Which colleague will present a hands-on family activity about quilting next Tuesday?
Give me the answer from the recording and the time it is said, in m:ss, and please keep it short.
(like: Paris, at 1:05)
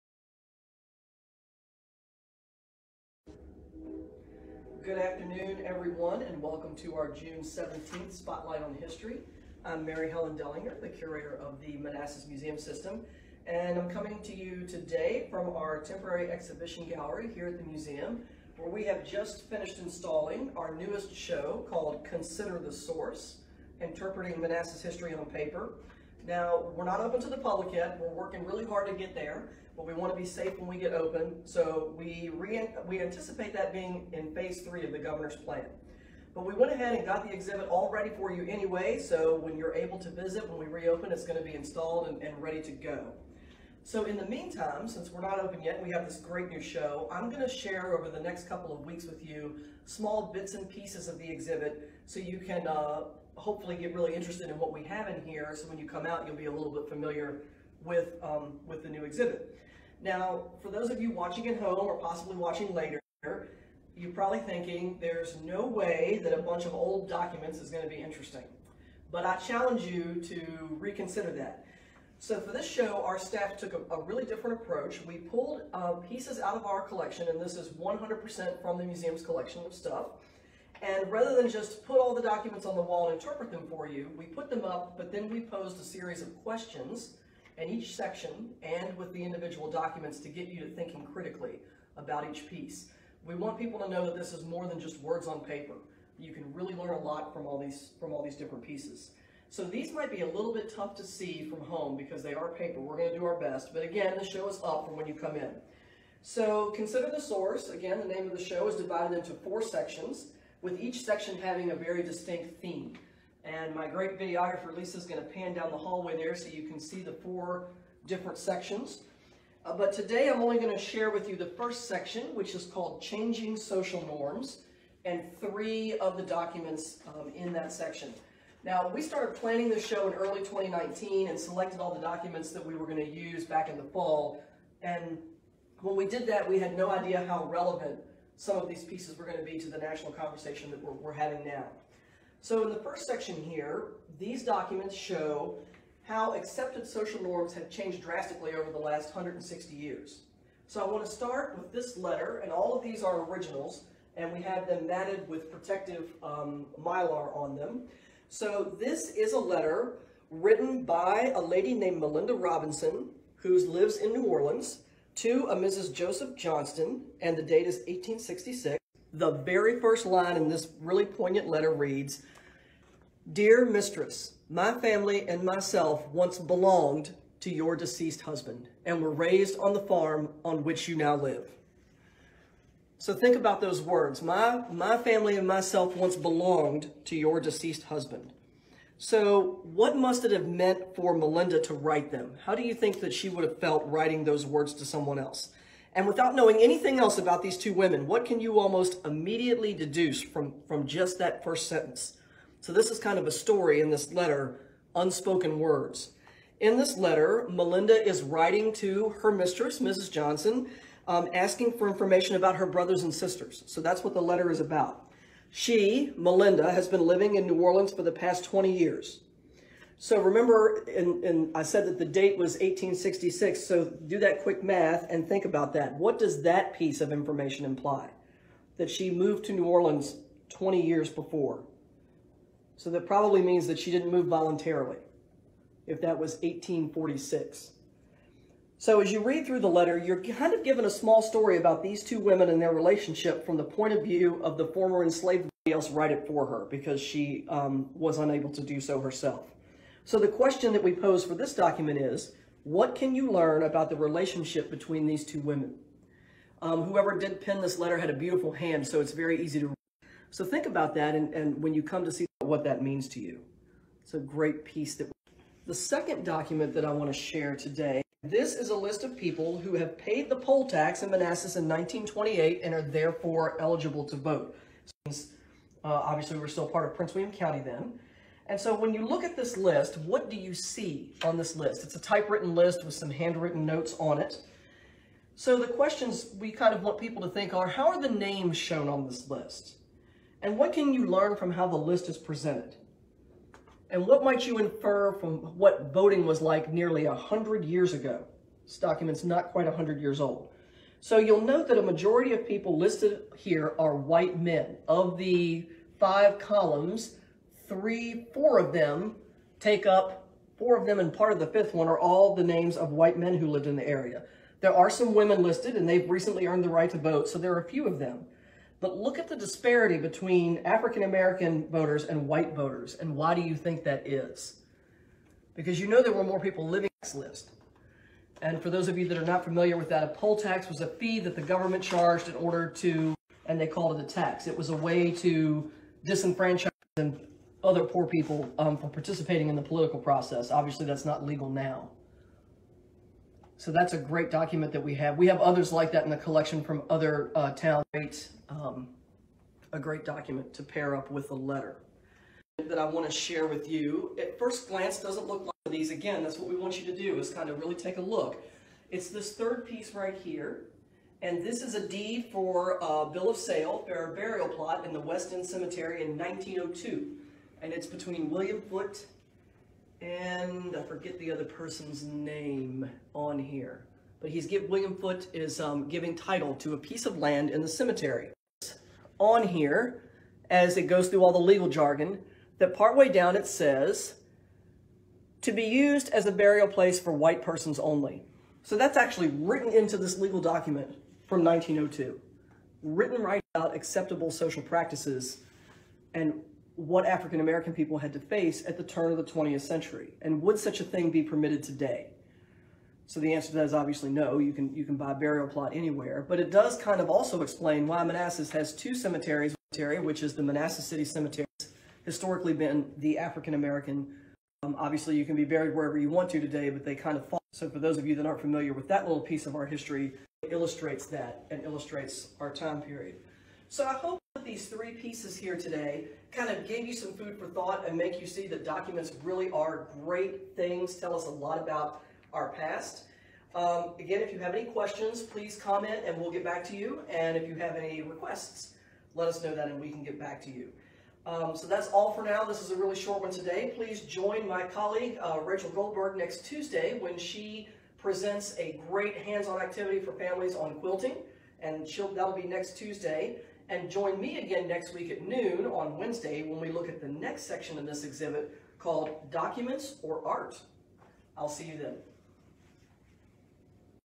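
Rachel Goldberg, at 7:25.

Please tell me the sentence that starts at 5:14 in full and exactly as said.
There are some women listed and they've recently earned the right to vote, so there are a few of them.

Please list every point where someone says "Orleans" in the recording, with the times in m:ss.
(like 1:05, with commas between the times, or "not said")
2:44, 3:37, 3:49.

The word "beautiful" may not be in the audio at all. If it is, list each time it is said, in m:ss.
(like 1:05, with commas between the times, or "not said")
4:18.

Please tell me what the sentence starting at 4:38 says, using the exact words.
And so when you look at this list, what do you see on this list?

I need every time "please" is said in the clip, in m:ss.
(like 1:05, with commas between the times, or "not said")
7:15, 7:23.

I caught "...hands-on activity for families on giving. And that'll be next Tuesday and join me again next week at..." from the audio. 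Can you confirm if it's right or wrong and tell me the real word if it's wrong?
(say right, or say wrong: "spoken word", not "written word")
wrong: "quilting", not "giving".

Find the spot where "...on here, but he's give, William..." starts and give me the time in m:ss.
6:13.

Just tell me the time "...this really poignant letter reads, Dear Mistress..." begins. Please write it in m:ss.
2:50.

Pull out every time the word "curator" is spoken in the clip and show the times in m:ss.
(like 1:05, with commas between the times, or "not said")
0:10.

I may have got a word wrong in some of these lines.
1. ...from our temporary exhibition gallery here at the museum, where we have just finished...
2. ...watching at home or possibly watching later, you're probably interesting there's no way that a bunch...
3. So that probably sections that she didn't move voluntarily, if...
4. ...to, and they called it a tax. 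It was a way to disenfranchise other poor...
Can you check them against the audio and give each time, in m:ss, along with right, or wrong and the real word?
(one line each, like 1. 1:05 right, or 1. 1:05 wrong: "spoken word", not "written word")
1. 0:15 right
2. 1:01 wrong: "thinking", not "interesting"
3. 3:52 wrong: "means", not "sections"
4. 5:32 right.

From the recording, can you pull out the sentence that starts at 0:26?
Now, we're not open to the public yet.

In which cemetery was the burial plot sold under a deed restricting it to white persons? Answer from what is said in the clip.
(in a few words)
West End Cemetery.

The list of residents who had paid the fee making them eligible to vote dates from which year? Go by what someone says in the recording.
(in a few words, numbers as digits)
1928.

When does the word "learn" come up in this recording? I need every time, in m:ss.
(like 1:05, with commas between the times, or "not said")
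1:36, 4:13, 4:51.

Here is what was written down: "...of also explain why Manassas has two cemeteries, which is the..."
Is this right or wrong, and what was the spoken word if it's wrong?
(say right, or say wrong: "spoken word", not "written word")
right.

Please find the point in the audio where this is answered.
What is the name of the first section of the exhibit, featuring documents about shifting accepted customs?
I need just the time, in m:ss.
2:03.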